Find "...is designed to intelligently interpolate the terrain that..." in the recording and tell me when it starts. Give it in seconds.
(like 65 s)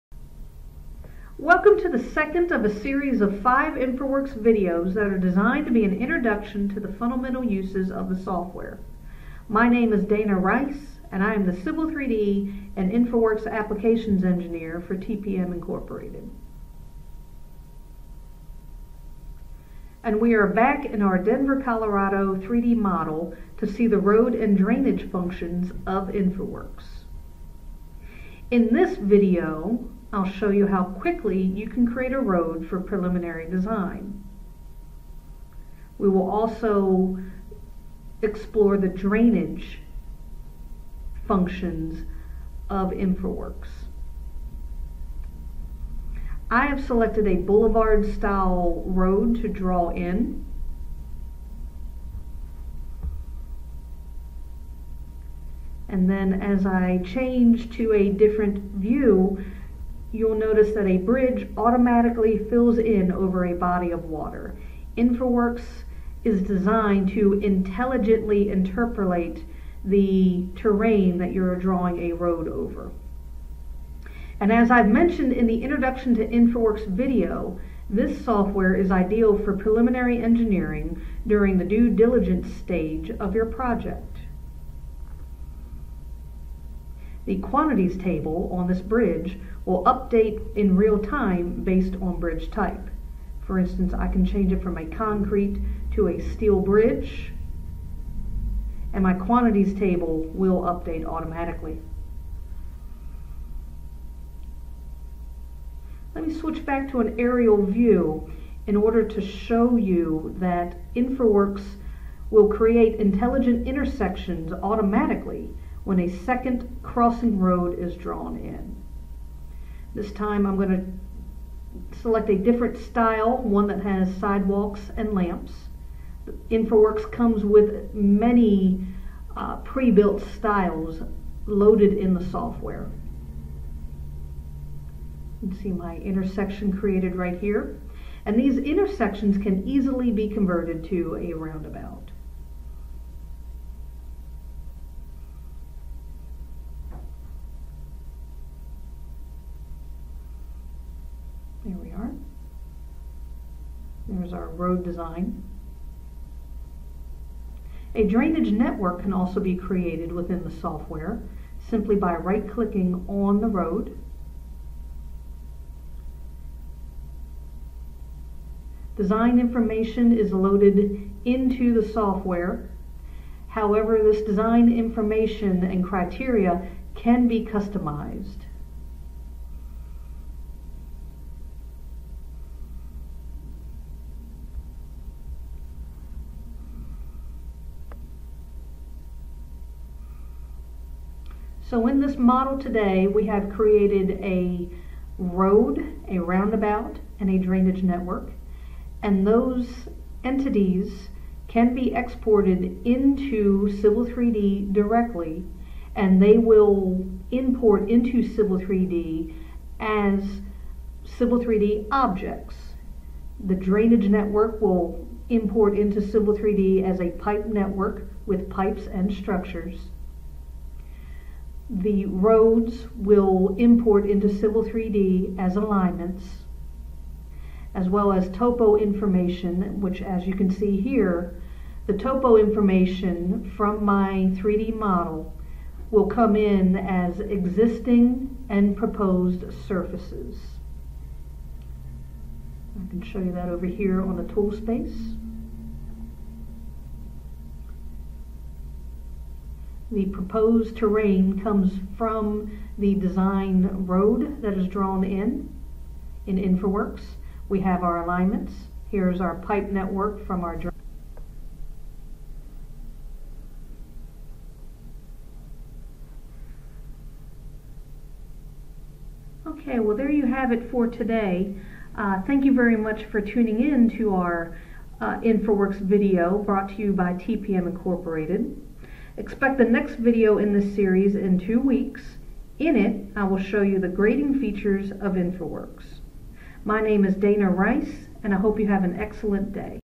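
66 s.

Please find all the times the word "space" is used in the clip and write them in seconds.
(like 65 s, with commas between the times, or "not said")
244 s.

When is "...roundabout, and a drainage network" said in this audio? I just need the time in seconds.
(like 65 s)
196 s.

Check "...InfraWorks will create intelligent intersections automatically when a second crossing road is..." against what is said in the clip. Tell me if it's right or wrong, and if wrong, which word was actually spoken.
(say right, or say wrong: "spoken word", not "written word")
right.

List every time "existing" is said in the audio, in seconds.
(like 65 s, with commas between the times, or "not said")
237 s.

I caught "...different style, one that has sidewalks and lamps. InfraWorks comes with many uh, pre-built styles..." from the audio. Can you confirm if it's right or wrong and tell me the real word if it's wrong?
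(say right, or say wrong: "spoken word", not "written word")
right.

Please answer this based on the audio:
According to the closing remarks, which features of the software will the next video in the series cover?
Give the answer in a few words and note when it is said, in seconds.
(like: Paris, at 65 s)
Grading features, at 283 s.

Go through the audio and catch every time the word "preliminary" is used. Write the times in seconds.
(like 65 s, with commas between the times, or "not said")
32 s, 79 s.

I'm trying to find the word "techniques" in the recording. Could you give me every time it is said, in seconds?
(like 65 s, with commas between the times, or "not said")
not said.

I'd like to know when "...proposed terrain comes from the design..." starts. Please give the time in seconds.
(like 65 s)
250 s.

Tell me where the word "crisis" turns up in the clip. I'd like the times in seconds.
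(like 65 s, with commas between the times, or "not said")
not said.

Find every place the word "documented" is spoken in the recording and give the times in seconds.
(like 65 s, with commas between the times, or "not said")
not said.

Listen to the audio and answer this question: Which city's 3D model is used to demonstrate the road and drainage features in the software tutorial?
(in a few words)
Denver, Colorado.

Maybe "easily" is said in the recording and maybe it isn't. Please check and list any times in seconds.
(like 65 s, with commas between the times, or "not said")
139 s.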